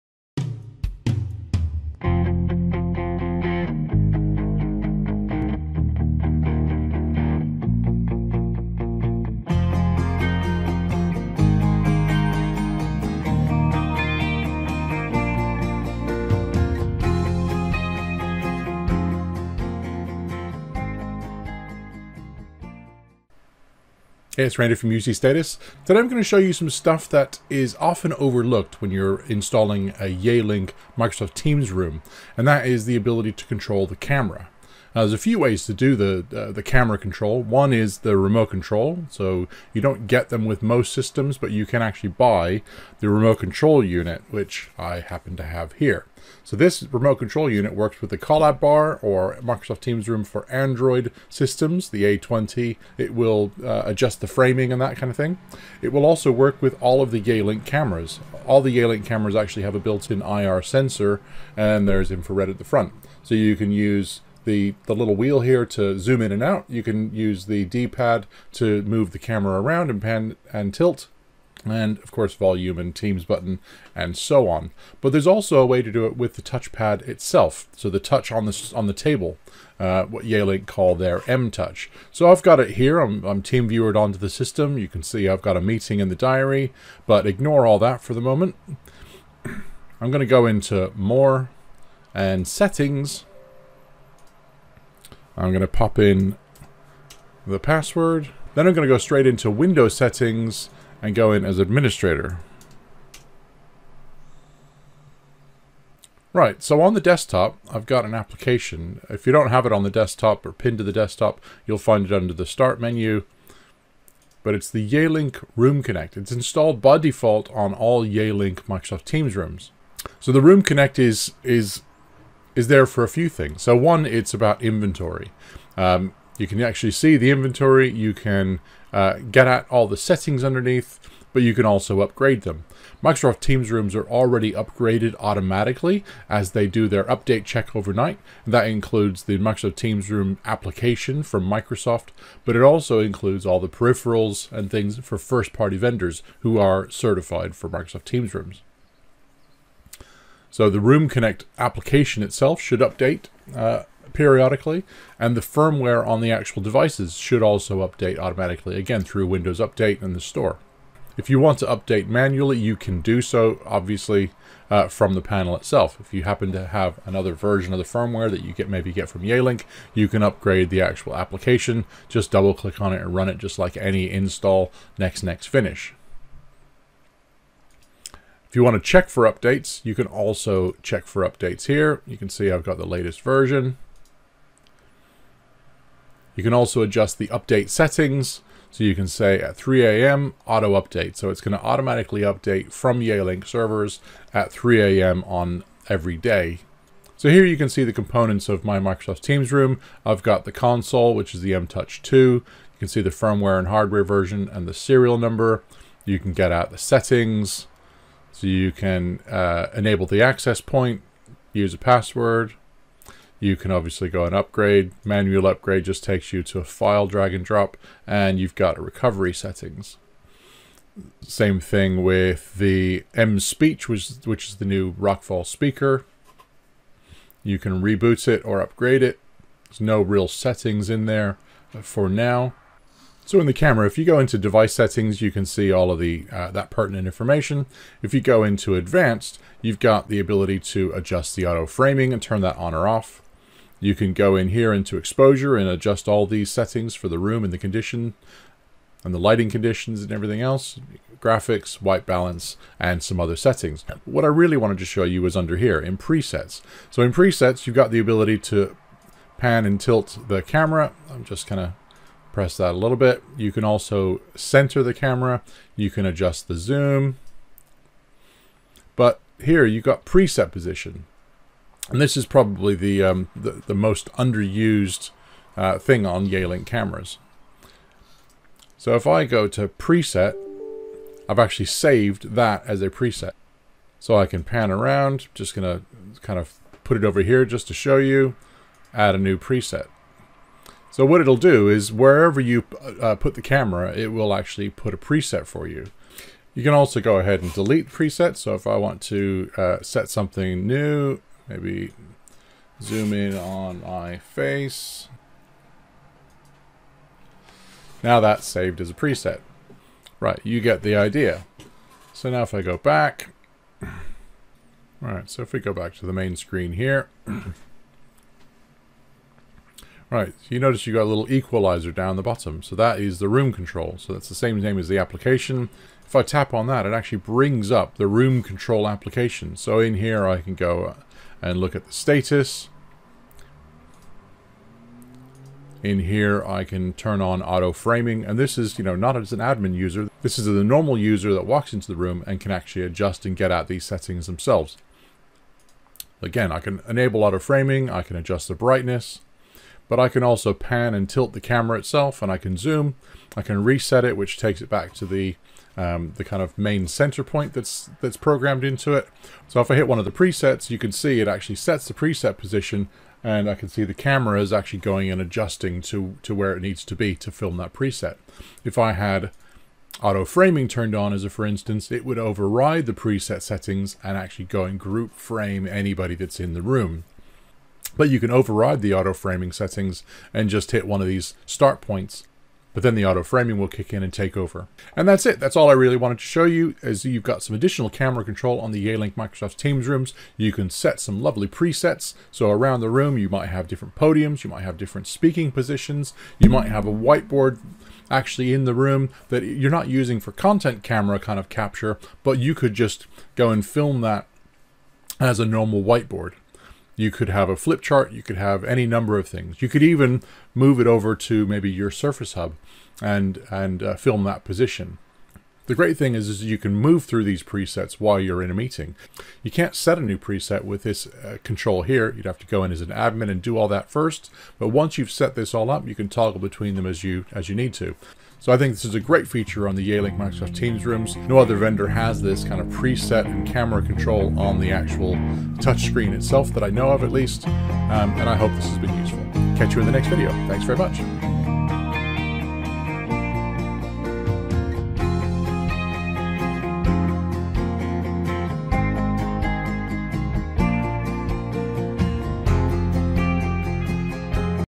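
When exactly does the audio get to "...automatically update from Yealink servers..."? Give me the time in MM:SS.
03:11.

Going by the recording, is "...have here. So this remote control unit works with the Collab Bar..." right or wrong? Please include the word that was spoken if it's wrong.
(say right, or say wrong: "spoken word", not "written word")
right.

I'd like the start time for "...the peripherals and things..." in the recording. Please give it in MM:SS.
02:23.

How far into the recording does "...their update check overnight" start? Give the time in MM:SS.
02:16.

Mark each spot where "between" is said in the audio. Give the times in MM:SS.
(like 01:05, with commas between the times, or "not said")
07:06.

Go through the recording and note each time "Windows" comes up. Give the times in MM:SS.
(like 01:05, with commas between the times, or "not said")
01:39, 02:39.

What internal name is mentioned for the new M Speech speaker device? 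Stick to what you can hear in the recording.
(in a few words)
Rockfall.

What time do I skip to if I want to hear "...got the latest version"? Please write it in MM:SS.
03:02.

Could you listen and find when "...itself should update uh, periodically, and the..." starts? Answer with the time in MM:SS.
02:32.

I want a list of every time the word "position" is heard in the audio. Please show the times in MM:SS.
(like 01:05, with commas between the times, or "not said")
04:30, 06:02, 06:35, 06:54.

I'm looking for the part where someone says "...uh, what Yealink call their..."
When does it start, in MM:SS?
01:19.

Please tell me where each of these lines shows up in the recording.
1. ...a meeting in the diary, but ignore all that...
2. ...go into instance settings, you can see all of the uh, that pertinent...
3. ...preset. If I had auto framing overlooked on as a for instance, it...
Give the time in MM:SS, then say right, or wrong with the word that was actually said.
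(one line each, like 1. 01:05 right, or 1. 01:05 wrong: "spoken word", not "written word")
1. 01:25 right
2. 03:54 wrong: "device", not "instance"
3. 06:07 wrong: "turned", not "overlooked".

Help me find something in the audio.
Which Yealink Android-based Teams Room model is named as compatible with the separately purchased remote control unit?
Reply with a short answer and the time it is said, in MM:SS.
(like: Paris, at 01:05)
A20, at 00:51.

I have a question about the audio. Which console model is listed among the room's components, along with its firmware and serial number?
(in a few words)
M-Touch 2.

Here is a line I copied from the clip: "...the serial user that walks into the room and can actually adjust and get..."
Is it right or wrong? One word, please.
wrong.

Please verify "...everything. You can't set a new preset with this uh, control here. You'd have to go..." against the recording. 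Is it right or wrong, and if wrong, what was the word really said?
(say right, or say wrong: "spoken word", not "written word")
wrong: "meeting", not "everything".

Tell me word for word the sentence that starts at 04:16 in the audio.
So in presets, you've got the ability to pan and tilt the camera.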